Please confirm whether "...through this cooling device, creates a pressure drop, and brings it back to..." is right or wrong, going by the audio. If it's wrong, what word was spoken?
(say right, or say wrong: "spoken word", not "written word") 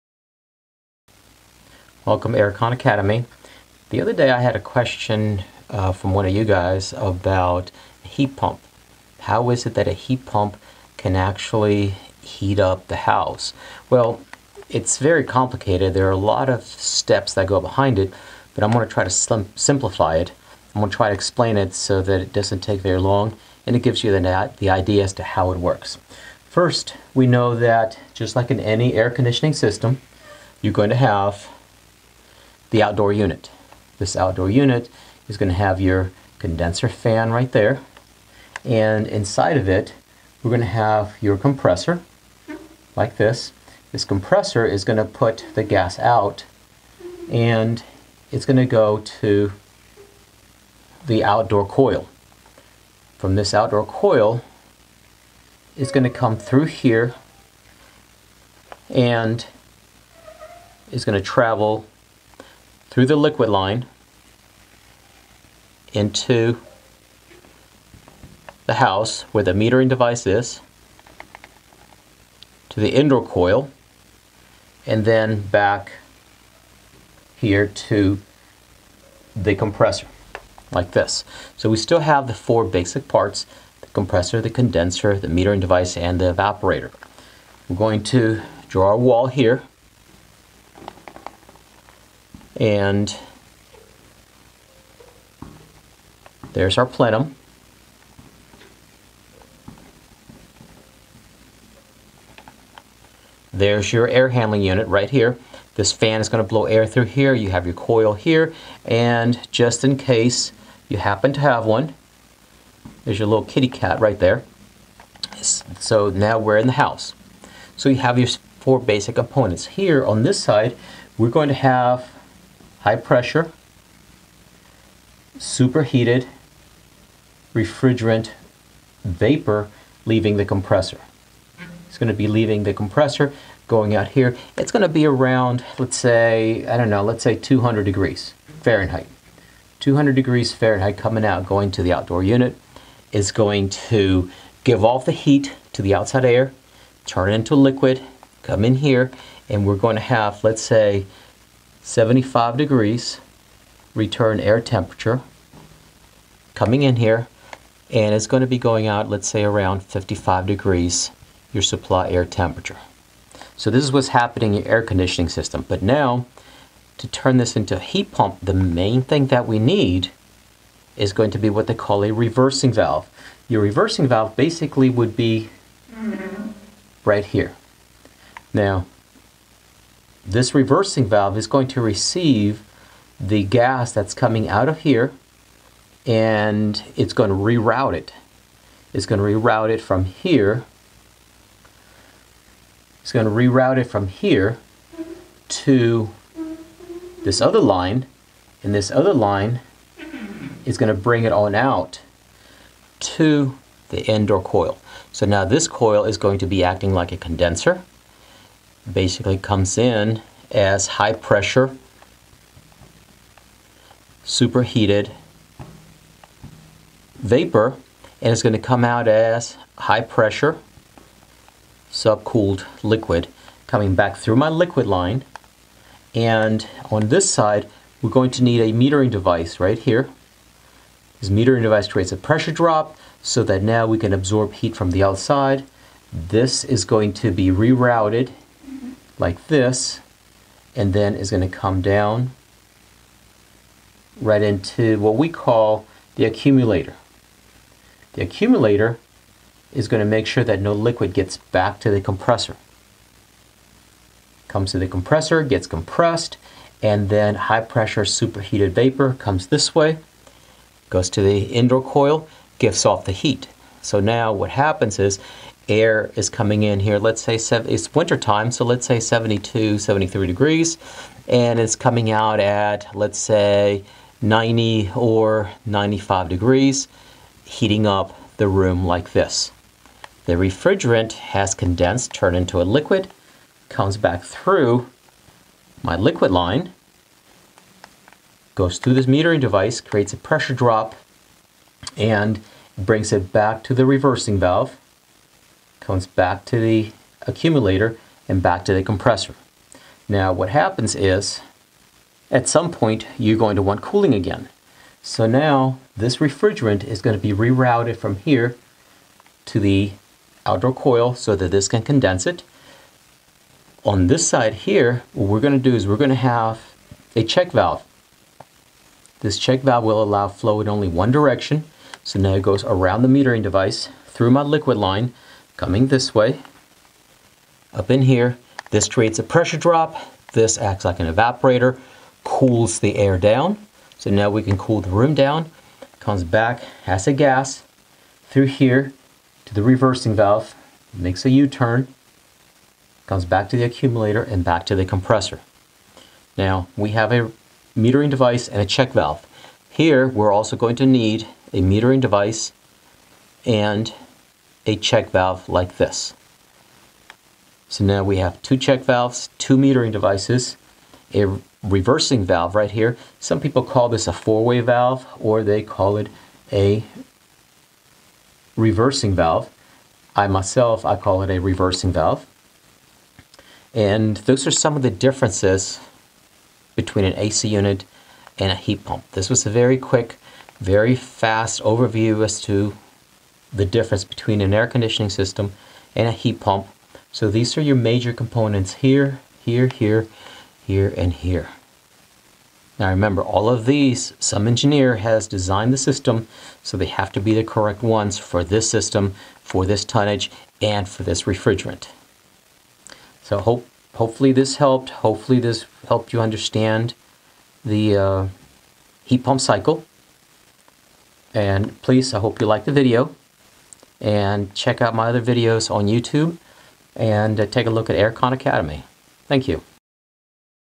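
wrong: "metering", not "cooling".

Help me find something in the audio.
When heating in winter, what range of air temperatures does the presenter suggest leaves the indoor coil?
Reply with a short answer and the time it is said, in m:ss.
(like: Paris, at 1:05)
90 or 95 degrees, at 4:34.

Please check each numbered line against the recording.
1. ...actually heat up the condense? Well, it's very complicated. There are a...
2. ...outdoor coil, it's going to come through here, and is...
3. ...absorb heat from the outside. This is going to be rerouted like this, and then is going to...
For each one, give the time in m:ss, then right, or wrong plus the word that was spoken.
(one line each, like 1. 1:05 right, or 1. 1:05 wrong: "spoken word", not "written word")
1. 0:11 wrong: "house", not "condense"
2. 0:53 right
3. 3:54 right.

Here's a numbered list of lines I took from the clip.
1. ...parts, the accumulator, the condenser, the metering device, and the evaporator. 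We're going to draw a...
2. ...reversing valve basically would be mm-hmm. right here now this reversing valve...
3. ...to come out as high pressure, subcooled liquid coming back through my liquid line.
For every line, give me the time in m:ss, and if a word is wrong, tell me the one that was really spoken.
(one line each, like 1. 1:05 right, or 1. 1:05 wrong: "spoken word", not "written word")
1. 1:23 wrong: "compressor", not "accumulator"
2. 2:53 right
3. 3:38 right.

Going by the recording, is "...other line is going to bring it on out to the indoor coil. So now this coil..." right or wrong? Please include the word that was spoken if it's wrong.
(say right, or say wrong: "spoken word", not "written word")
right.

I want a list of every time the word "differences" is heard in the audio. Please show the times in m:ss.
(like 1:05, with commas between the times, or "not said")
6:14, 6:23.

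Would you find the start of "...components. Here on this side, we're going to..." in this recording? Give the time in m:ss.
1:59.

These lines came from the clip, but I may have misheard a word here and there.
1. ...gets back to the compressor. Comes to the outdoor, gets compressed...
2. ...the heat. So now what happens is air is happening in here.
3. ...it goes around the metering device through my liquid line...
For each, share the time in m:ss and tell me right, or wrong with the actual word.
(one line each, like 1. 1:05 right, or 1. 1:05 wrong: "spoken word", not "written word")
1. 4:11 wrong: "compressor", not "outdoor"
2. 4:23 wrong: "coming", not "happening"
3. 5:22 right.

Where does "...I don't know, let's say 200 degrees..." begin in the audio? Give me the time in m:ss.
2:16.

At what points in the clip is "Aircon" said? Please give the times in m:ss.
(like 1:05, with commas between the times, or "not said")
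0:02, 6:57.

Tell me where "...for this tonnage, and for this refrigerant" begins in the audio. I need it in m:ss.
6:39.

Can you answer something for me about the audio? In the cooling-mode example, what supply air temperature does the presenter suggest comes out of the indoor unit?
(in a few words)
55 degrees.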